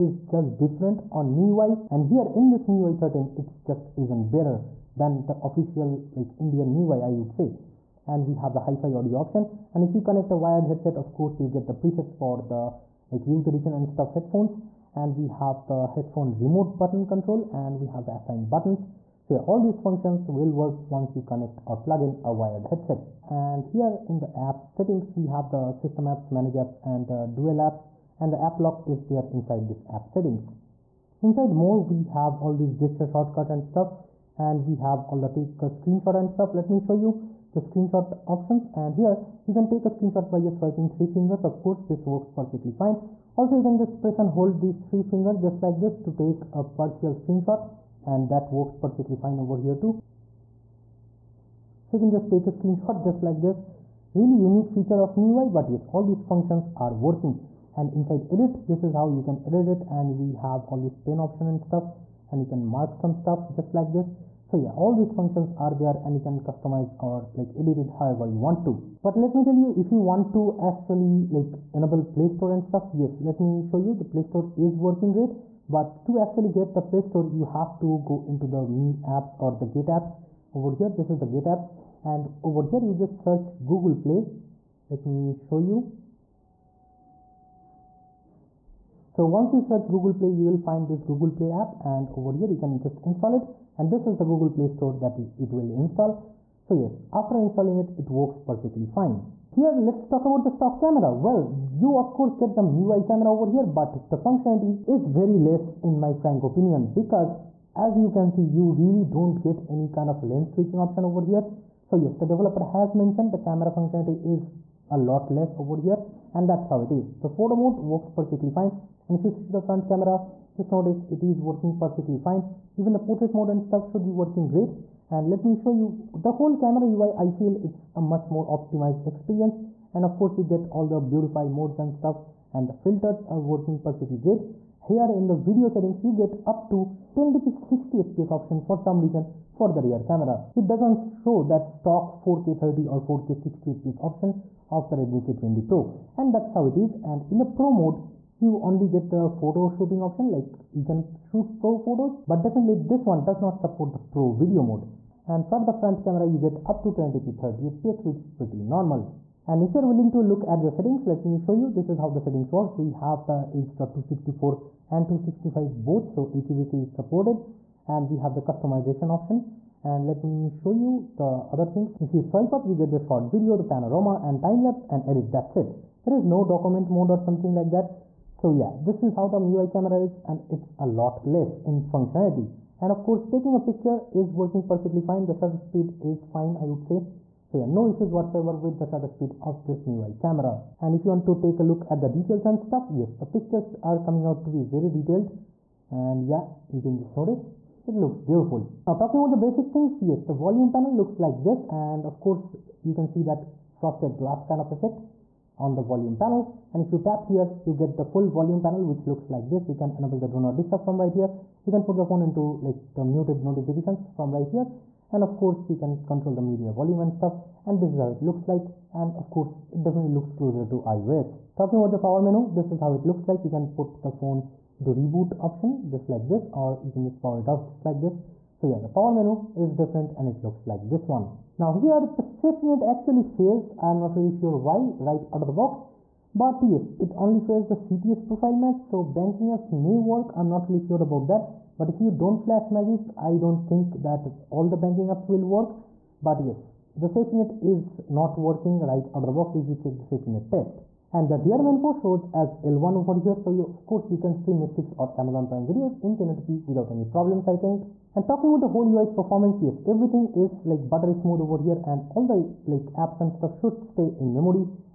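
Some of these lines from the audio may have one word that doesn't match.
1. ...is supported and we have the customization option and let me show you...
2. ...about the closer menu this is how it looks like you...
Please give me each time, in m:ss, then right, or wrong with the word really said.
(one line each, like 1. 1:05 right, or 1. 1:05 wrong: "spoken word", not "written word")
1. 2:46 right
2. 3:41 wrong: "power", not "closer".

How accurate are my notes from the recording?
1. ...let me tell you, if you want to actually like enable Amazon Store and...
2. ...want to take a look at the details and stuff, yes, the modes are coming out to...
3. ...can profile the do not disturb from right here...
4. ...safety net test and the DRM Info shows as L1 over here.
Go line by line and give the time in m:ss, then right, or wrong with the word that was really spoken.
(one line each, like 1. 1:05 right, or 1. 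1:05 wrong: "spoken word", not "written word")
1. 1:09 wrong: "Play", not "Amazon"
2. 3:11 wrong: "pictures", not "modes"
3. 3:29 wrong: "enable", not "profile"
4. 4:10 right.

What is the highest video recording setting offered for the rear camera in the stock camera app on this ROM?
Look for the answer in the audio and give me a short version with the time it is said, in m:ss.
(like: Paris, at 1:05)
1080p 60 fps, at 2:17.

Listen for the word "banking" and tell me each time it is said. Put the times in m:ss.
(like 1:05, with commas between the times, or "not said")
3:59, 4:04.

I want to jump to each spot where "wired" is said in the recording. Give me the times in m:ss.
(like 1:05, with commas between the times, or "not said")
0:10, 0:22.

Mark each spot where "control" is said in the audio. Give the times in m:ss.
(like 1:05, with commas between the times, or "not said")
0:17, 3:36.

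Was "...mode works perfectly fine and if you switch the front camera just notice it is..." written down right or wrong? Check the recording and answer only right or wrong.
right.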